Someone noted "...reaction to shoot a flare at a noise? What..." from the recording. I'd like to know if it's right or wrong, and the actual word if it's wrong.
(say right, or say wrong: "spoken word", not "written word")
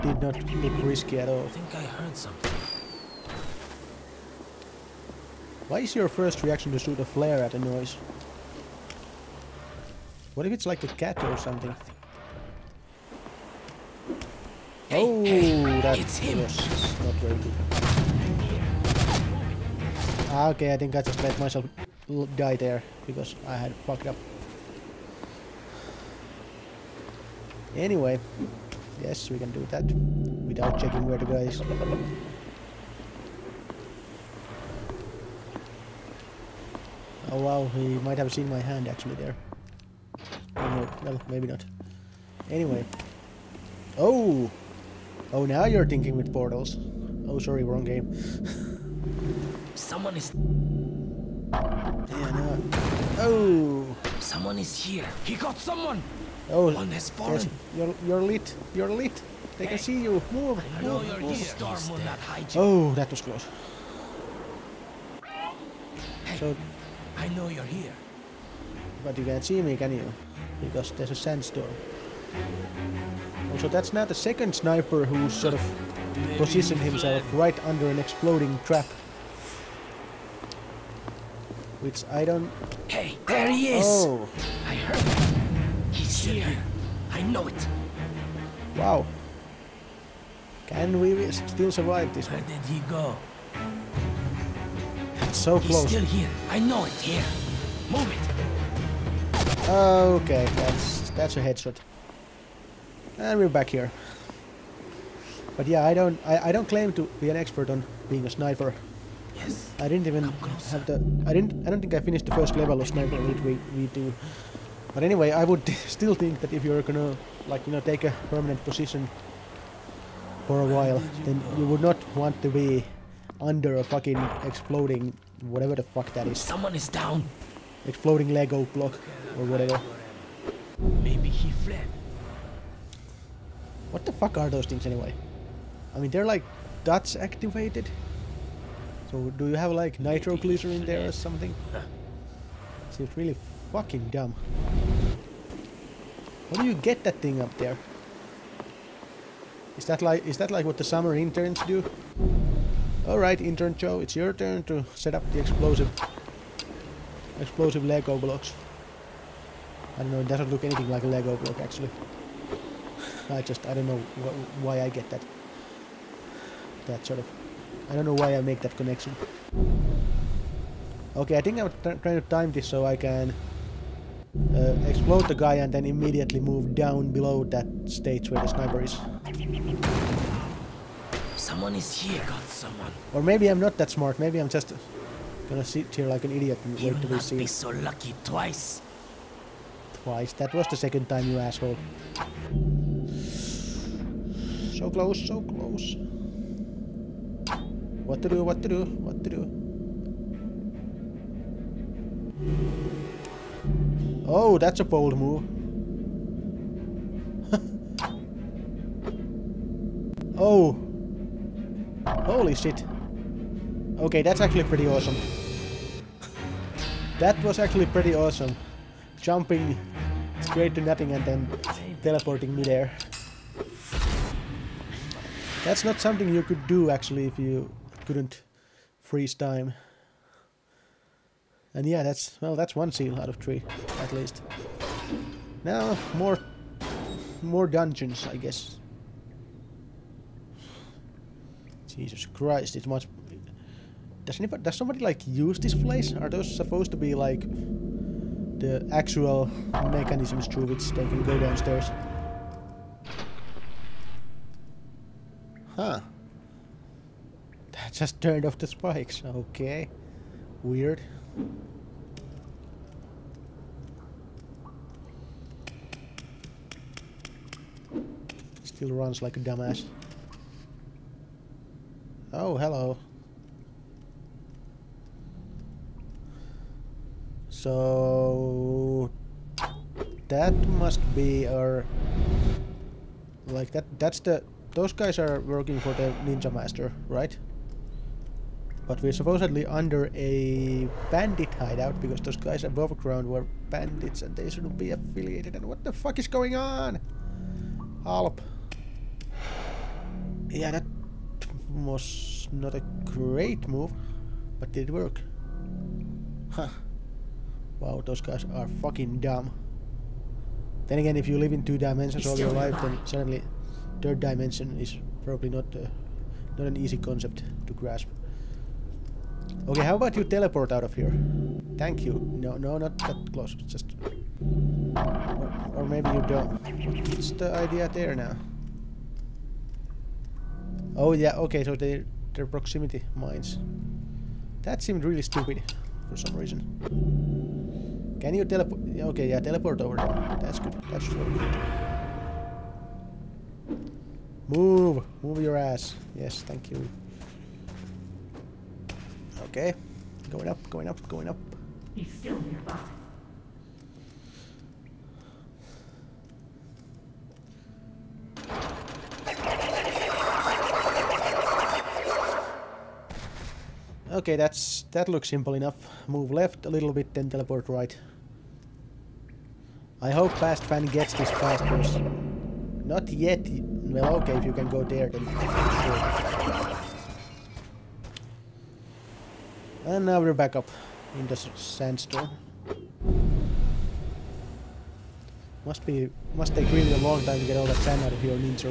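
right.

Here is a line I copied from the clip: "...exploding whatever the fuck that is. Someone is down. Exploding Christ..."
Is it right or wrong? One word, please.
wrong.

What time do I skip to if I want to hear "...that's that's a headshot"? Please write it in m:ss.
1:40.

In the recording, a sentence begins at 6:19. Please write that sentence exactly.
And now we're back up in the sandstorm.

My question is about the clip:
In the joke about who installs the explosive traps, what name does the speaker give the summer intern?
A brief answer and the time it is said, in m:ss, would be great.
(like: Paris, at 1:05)
Joe, at 2:33.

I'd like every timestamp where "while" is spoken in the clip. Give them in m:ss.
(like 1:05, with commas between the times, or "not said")
2:00.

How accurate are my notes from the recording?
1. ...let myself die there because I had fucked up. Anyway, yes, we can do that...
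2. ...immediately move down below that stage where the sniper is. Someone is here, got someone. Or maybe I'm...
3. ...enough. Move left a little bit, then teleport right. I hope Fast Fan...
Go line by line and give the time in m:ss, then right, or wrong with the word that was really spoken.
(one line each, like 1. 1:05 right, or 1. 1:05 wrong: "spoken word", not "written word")
1. 0:21 right
2. 2:55 right
3. 6:05 right.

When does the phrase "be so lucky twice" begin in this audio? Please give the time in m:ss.
3:07.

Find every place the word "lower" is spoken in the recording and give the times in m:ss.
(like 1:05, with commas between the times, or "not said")
not said.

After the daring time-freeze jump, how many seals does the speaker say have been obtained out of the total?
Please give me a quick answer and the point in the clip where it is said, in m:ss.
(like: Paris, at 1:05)
1 out of 3, at 3:52.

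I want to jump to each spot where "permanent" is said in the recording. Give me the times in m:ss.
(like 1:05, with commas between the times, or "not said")
1:58.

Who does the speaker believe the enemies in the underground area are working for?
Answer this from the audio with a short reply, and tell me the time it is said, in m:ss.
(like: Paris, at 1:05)
the Ninja Master, at 4:46.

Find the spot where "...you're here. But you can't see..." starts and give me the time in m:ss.
1:07.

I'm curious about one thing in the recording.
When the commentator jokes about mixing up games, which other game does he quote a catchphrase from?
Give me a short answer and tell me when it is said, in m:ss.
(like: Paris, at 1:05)
Portals, at 0:45.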